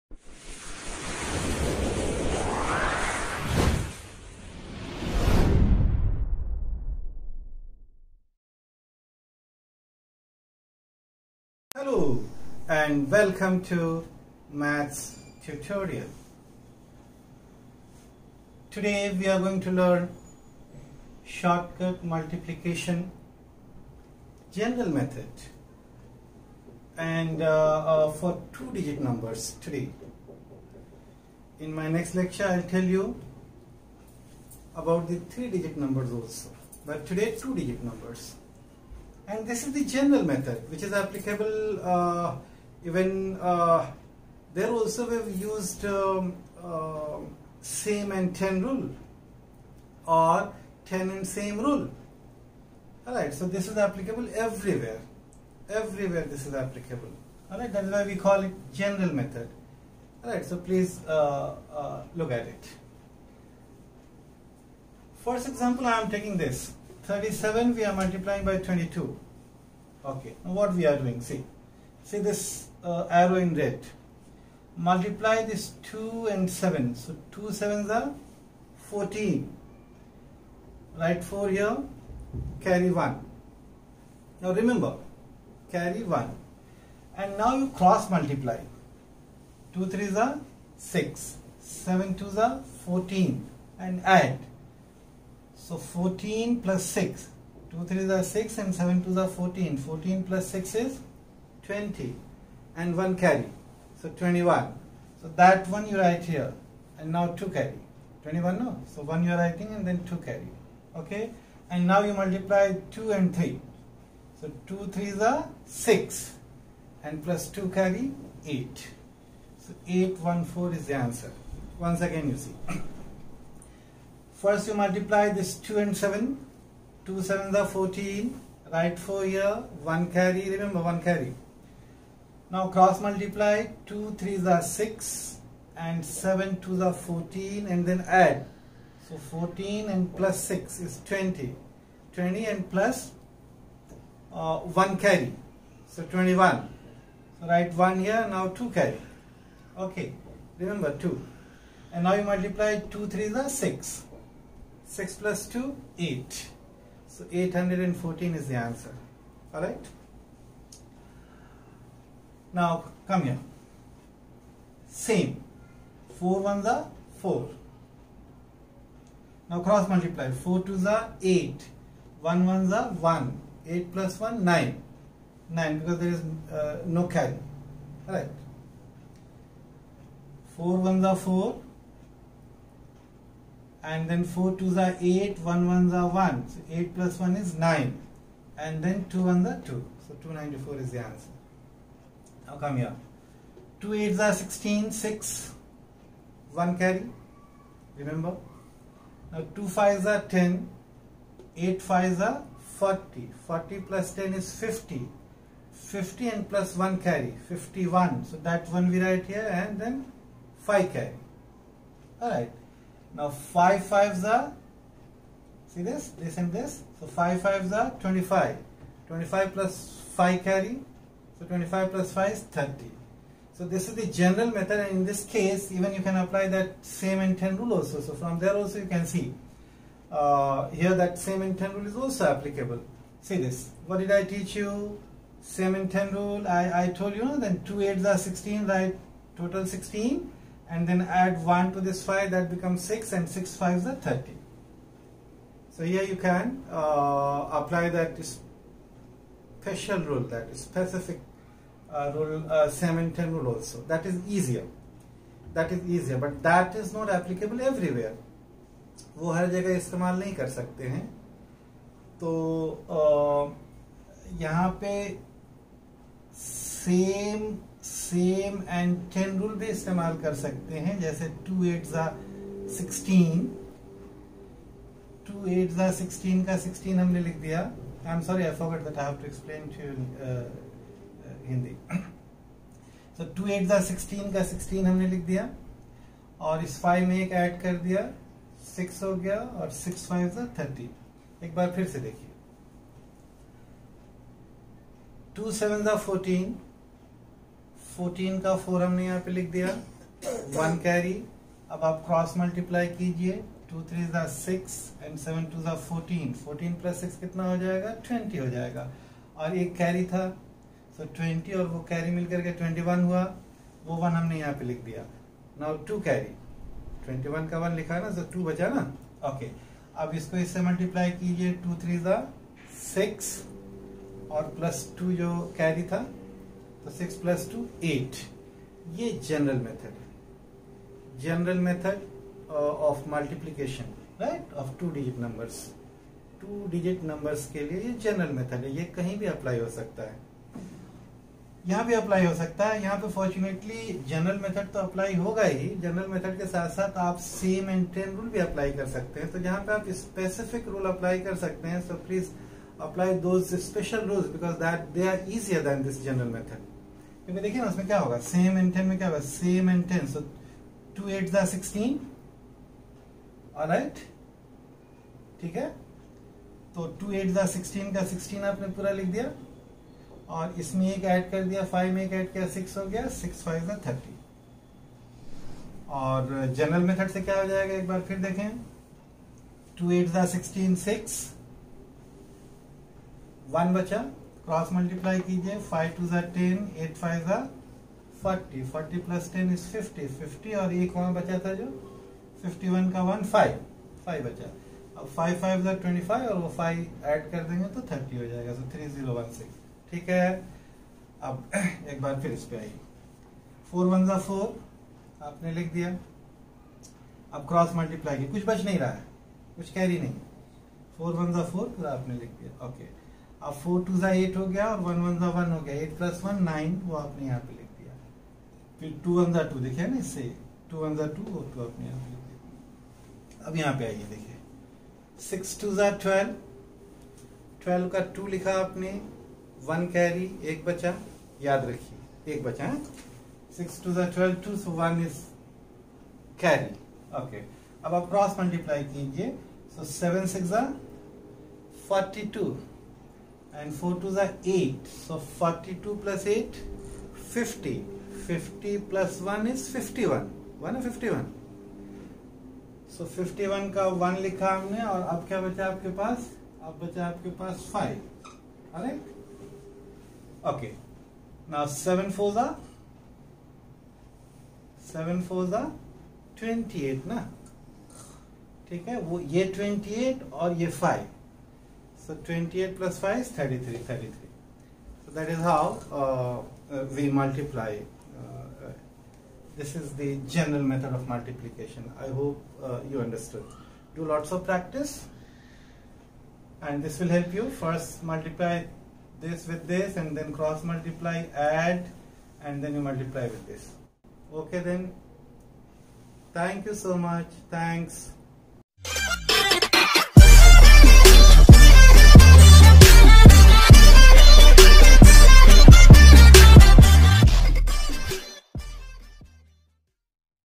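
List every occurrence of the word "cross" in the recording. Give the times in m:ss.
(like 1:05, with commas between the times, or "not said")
1:27, 2:12, 2:49, 8:10.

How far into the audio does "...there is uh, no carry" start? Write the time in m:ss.
2:55.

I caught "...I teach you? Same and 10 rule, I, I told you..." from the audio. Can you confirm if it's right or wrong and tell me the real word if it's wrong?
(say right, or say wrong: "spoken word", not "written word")
right.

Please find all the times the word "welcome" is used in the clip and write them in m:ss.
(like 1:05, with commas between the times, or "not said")
0:13.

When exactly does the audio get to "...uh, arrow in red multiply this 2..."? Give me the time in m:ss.
1:12.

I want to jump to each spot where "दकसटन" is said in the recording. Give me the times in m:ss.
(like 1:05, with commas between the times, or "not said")
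6:01, 6:07, 6:20.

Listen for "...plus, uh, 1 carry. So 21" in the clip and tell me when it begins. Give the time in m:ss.
2:22.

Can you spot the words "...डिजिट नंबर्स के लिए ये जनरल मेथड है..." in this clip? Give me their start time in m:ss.
5:36.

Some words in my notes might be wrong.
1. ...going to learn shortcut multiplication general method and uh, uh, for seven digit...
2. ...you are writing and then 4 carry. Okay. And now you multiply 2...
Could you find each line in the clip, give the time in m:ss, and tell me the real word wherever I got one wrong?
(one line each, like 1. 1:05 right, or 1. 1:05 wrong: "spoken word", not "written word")
1. 0:19 wrong: "two", not "seven"
2. 1:49 wrong: "2", not "4".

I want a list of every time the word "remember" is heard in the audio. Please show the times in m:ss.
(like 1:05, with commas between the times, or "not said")
1:24, 2:10, 2:30, 3:17.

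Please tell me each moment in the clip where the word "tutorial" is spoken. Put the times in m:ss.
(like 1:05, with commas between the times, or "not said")
0:15.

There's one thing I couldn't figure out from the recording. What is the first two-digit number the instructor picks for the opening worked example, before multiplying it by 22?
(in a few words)
37.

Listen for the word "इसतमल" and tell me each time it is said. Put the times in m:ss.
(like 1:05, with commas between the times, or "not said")
4:19, 4:29.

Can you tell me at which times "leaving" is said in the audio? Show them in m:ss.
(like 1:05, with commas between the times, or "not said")
not said.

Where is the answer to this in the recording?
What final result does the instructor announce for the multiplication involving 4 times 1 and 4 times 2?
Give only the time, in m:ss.
3:10.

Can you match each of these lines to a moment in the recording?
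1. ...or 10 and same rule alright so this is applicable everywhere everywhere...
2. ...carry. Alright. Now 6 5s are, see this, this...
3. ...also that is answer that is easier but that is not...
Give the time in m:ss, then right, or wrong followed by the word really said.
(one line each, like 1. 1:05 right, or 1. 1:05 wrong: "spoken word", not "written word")
1. 0:50 right
2. 3:30 wrong: "5", not "6"
3. 4:13 wrong: "easier", not "answer".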